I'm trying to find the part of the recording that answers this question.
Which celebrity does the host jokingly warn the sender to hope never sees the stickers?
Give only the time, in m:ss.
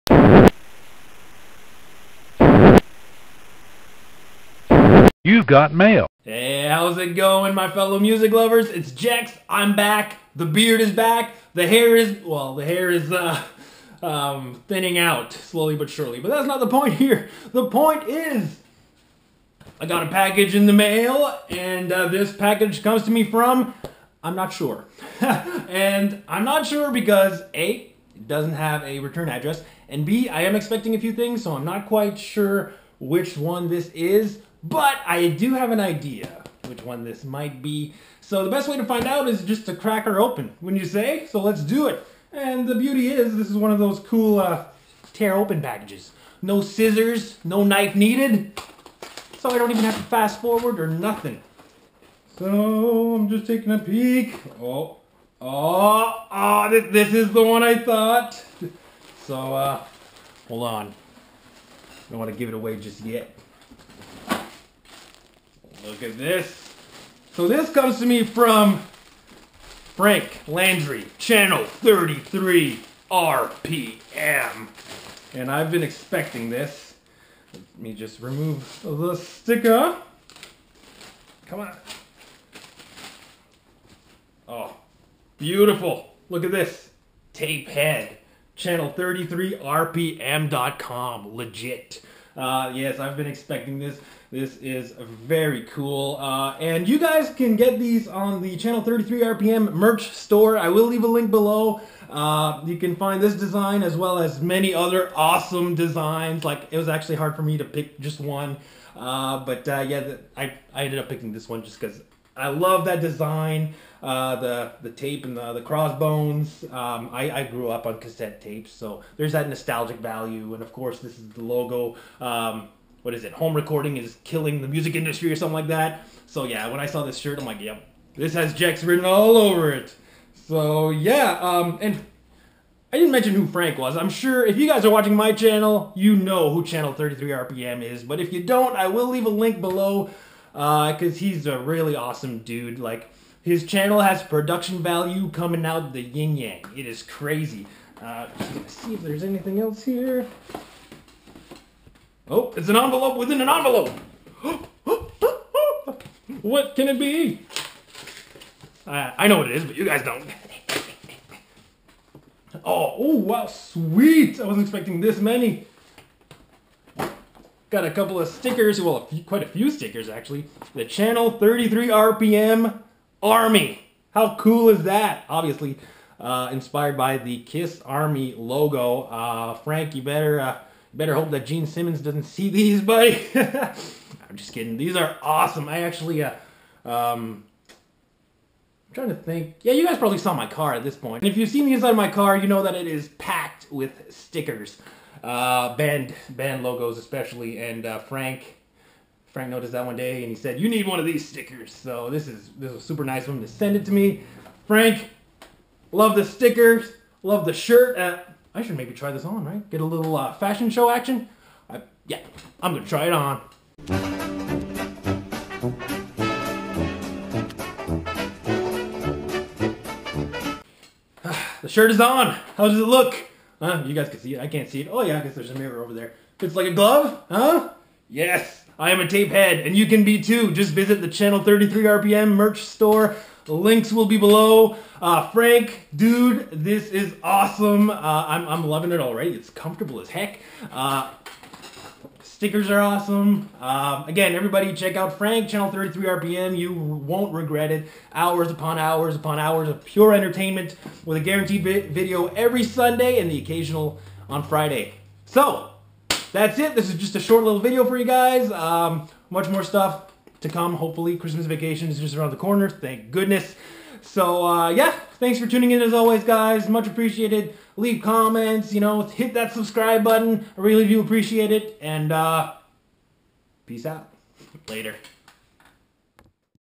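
3:01.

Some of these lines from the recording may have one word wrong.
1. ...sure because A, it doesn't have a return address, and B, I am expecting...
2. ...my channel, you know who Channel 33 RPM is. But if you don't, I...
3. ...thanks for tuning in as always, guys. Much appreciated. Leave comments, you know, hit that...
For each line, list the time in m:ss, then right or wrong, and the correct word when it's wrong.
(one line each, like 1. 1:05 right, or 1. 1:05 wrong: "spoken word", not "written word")
1. 0:26 right
2. 2:15 right
3. 4:25 right.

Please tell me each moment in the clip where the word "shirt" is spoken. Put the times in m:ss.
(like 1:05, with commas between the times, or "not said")
2:07, 3:27, 3:41.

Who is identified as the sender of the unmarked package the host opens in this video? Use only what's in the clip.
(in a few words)
Frank Landry.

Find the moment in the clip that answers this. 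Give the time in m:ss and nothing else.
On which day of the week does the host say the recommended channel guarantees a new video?
4:12.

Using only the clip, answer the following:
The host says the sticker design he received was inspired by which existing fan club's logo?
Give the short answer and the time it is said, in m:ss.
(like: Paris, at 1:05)
KISS Army, at 2:57.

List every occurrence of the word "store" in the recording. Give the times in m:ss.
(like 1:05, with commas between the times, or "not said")
1:40, 3:52.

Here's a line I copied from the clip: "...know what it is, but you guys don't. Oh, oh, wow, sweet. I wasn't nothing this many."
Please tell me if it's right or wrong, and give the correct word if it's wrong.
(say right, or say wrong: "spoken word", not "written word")
wrong: "expecting", not "nothing".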